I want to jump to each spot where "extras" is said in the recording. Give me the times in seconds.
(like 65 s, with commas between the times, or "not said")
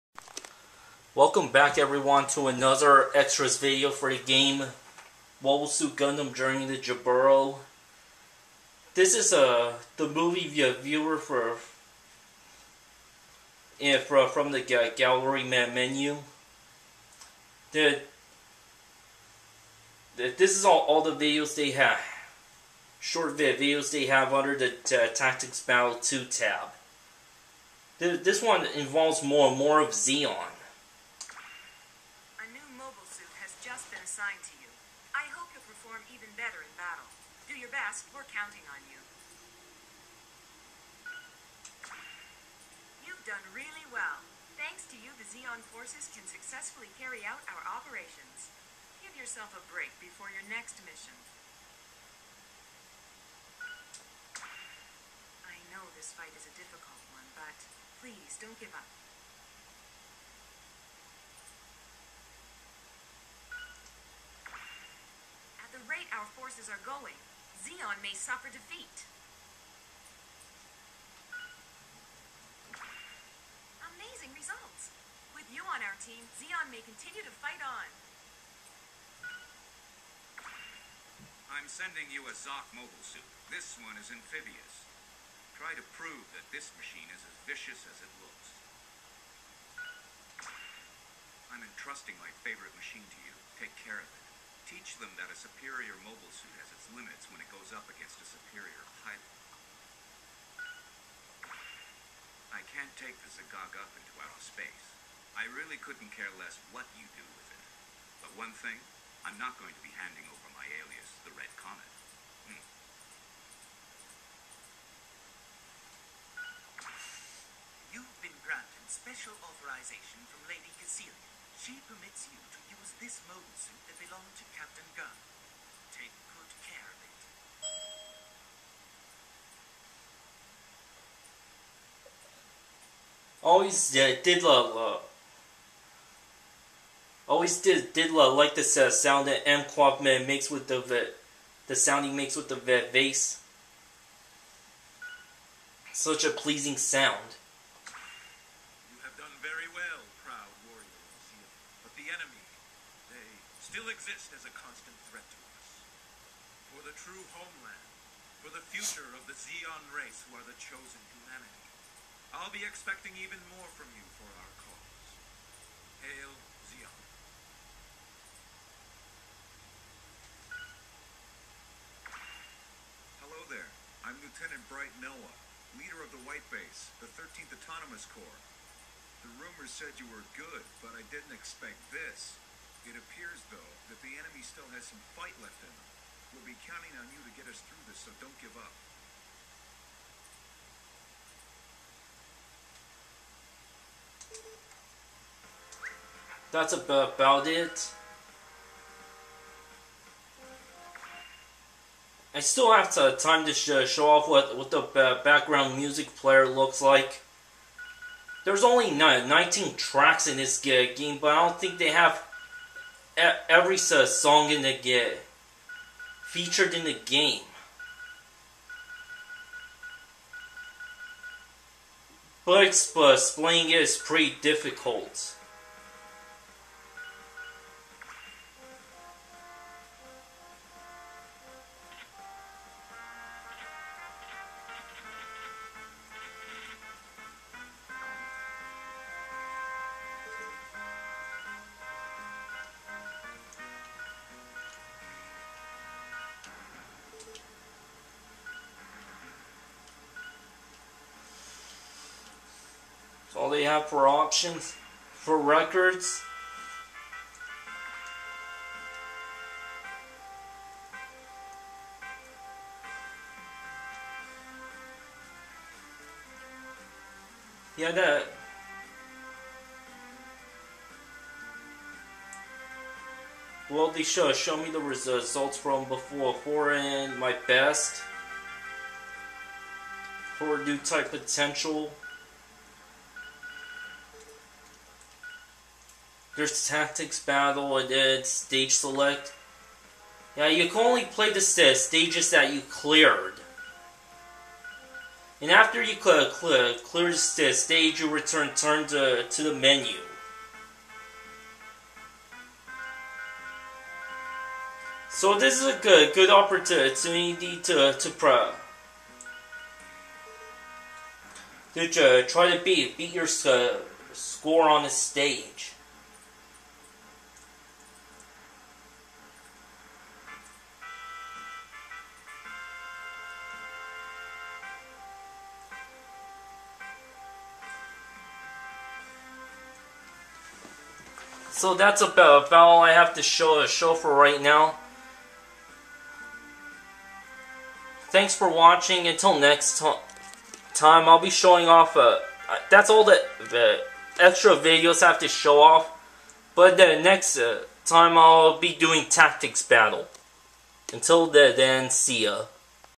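3 s, 344 s.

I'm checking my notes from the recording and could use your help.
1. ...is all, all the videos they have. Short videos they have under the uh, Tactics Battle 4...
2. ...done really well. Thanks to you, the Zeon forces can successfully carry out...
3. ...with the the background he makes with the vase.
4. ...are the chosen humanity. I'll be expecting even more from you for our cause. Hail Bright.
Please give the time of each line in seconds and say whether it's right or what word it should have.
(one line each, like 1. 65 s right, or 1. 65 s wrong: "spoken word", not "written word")
1. 20 s wrong: "2", not "4"
2. 43 s right
3. 140 s wrong: "sound", not "background"
4. 160 s wrong: "Zeon", not "Bright".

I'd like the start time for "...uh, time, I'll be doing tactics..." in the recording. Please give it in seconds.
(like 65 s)
347 s.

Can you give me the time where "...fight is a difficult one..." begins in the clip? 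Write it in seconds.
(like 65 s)
56 s.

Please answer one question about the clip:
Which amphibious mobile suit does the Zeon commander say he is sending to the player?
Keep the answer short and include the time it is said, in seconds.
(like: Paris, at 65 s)
Zock, at 82 s.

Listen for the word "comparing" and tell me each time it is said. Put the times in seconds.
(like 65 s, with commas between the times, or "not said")
not said.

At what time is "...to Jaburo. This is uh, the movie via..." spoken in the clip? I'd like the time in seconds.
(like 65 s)
6 s.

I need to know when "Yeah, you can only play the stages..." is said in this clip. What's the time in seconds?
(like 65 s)
290 s.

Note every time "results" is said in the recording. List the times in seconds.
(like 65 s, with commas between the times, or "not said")
74 s, 274 s.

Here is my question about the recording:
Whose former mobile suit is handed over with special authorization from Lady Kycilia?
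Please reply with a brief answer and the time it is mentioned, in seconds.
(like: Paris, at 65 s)
Captain Gunn, at 124 s.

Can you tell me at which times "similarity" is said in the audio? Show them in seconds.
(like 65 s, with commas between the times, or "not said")
not said.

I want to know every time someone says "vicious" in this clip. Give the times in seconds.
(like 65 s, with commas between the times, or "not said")
87 s.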